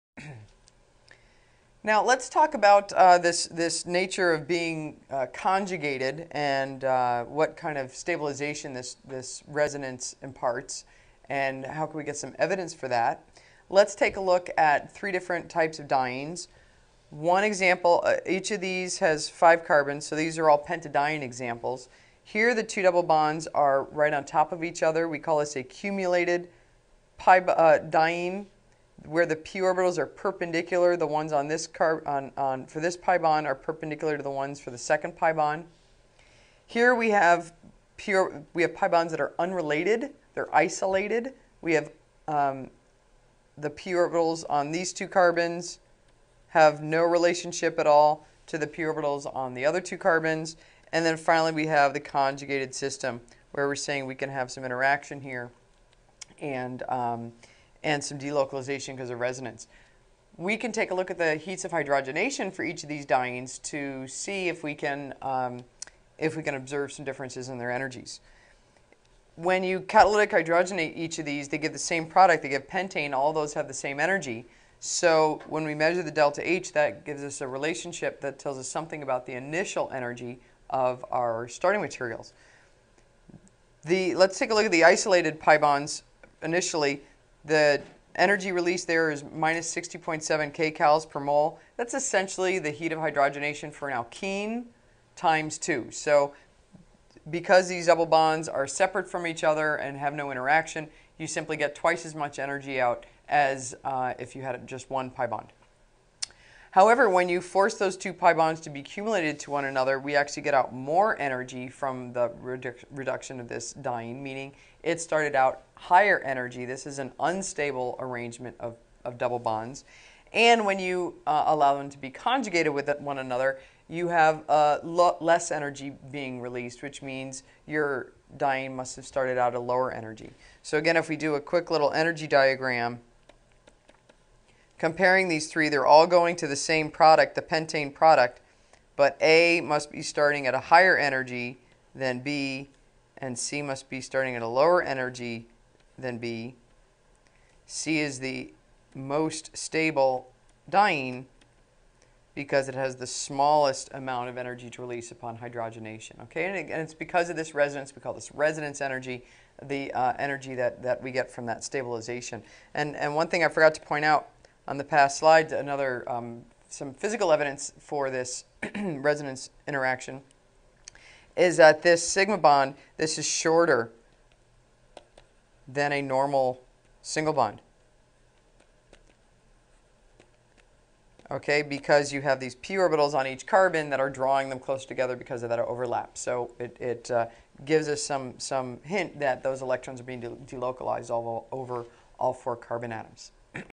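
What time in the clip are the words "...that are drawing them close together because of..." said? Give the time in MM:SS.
03:03.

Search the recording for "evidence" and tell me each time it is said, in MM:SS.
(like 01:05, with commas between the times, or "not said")
00:12, 02:47.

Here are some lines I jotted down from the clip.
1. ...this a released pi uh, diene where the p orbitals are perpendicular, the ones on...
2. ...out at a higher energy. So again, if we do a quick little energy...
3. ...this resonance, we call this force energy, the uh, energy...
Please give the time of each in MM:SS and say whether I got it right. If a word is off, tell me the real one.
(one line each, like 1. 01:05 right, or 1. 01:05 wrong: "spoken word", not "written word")
1. 00:25 wrong: "cumulated", not "released"
2. 02:09 wrong: "lower", not "higher"
3. 02:37 wrong: "resonance", not "force".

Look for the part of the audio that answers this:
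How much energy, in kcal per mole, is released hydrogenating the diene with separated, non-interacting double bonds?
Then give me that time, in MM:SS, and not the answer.
01:29.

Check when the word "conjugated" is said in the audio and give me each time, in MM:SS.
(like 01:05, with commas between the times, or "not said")
00:05, 00:52, 02:02.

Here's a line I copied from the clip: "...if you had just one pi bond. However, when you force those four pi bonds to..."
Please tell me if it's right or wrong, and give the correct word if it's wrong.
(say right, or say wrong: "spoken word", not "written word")
wrong: "two", not "four".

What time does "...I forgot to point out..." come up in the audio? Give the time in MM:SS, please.
02:43.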